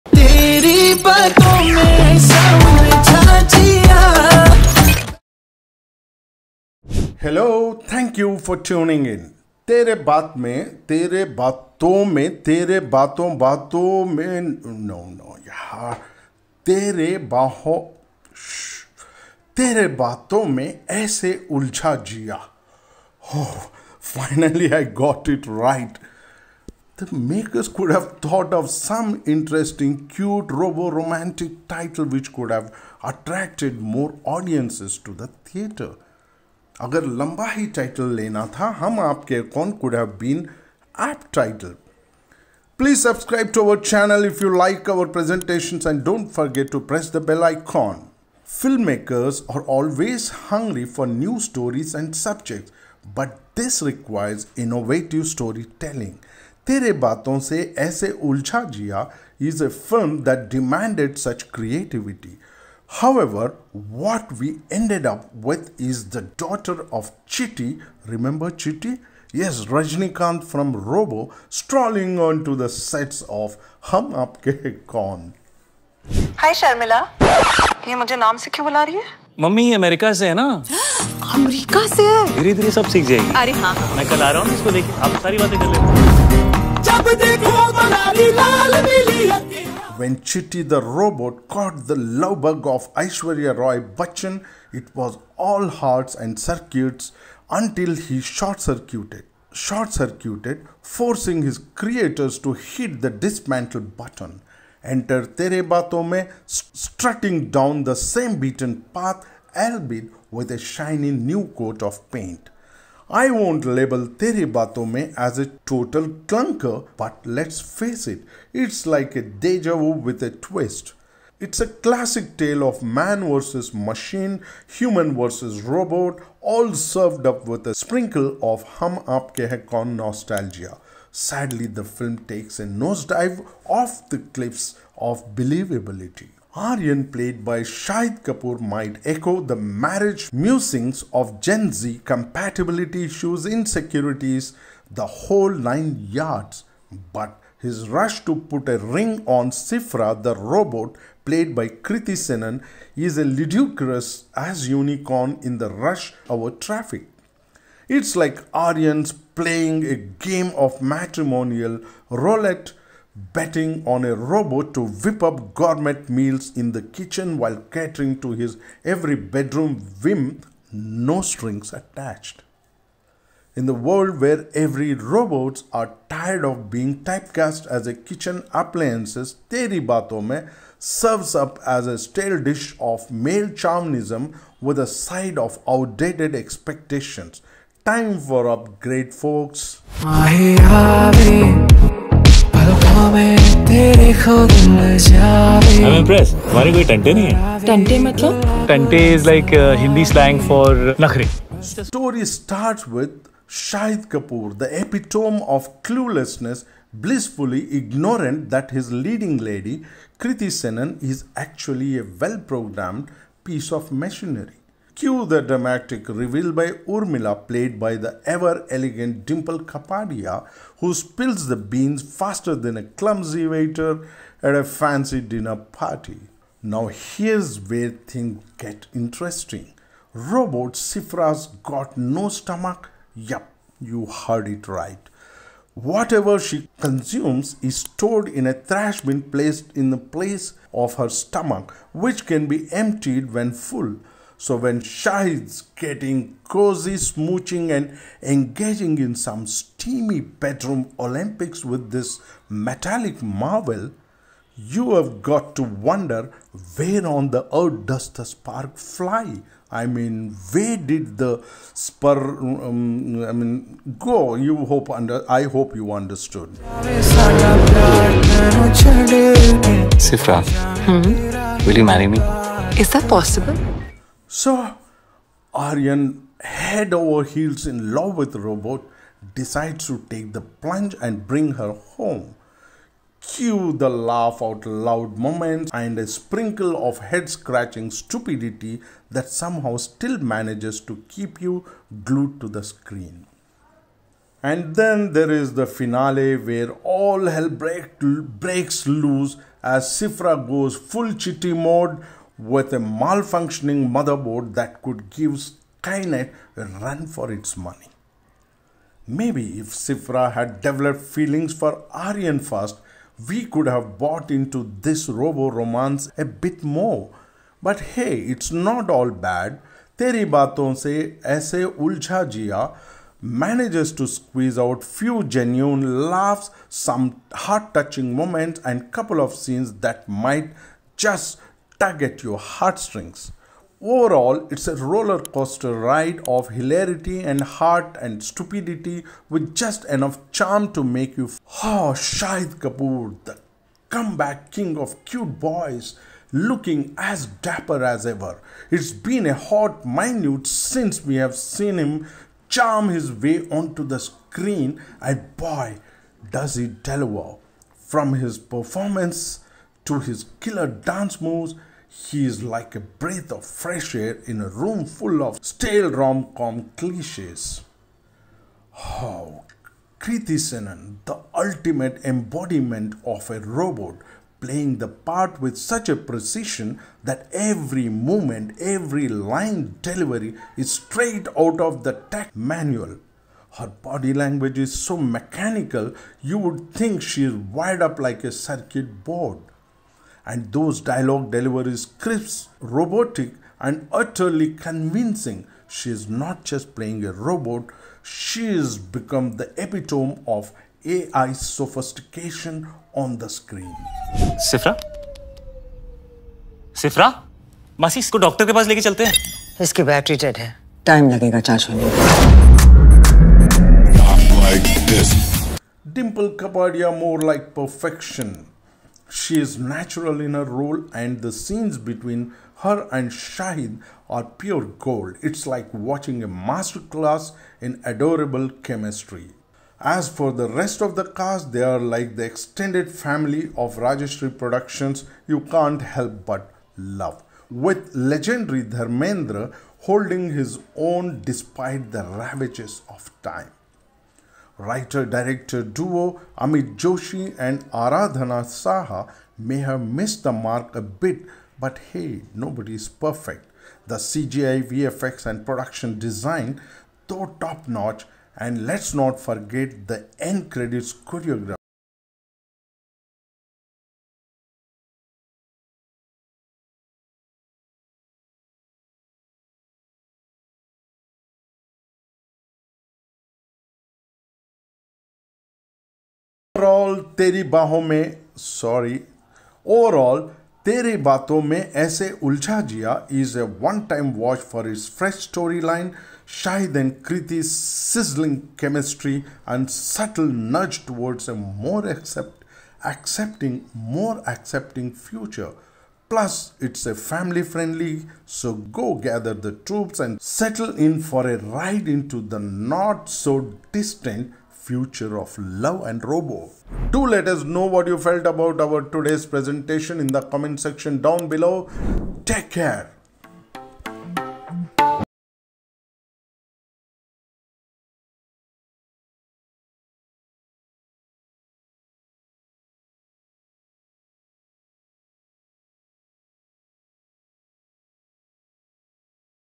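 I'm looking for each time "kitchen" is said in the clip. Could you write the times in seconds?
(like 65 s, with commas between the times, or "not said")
166 s, 177 s.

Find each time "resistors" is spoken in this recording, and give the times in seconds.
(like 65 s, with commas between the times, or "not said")
not said.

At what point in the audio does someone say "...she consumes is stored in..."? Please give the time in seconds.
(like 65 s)
236 s.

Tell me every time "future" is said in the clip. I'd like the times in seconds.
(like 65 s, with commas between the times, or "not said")
495 s, 504 s.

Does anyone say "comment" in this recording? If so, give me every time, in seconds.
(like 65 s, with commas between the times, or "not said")
510 s.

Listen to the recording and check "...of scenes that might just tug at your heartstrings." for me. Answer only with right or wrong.
right.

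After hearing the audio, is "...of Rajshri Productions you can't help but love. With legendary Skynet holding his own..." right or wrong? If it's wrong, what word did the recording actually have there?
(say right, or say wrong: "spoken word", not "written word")
wrong: "Dharmendra", not "Skynet".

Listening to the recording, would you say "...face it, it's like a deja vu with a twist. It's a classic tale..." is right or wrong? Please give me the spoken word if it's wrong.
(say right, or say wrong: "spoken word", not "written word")
right.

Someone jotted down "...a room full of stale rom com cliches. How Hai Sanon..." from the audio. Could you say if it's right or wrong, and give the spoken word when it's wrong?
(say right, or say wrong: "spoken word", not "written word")
wrong: "Kriti", not "Hai".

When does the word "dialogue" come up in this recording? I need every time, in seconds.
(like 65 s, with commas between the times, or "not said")
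390 s.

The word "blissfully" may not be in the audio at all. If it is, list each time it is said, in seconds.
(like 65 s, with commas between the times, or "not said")
207 s.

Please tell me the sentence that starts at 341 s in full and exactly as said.
Oh, Shahid Kapoor, the comeback king of cute boys, looking as dapper as ever.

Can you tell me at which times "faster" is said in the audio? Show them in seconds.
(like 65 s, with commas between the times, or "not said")
222 s.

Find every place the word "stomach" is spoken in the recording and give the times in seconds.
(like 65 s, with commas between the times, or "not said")
232 s, 241 s.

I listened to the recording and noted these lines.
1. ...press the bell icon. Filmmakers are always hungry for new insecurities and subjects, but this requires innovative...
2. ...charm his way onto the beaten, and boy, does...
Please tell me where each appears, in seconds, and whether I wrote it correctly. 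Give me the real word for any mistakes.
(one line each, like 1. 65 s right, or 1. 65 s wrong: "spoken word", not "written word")
1. 46 s wrong: "stories", not "insecurities"
2. 352 s wrong: "screen", not "beaten".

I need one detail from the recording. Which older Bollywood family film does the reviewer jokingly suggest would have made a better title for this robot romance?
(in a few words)
Hum Aapke Kaun.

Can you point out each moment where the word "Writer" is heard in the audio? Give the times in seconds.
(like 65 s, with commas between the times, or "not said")
444 s.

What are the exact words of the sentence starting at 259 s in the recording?
I mean, where did the spur?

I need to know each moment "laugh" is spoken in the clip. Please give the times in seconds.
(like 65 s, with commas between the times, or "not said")
283 s, 326 s.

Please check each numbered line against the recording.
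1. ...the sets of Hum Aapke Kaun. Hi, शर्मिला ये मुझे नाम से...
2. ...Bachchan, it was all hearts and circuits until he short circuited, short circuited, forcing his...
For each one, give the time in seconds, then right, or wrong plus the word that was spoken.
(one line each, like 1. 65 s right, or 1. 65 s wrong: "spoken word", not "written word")
1. 72 s right
2. 93 s right.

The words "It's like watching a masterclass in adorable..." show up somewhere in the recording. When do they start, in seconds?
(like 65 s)
425 s.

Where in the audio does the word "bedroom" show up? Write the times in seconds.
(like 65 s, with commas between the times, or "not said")
169 s, 250 s.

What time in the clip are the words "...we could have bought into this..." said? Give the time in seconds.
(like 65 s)
313 s.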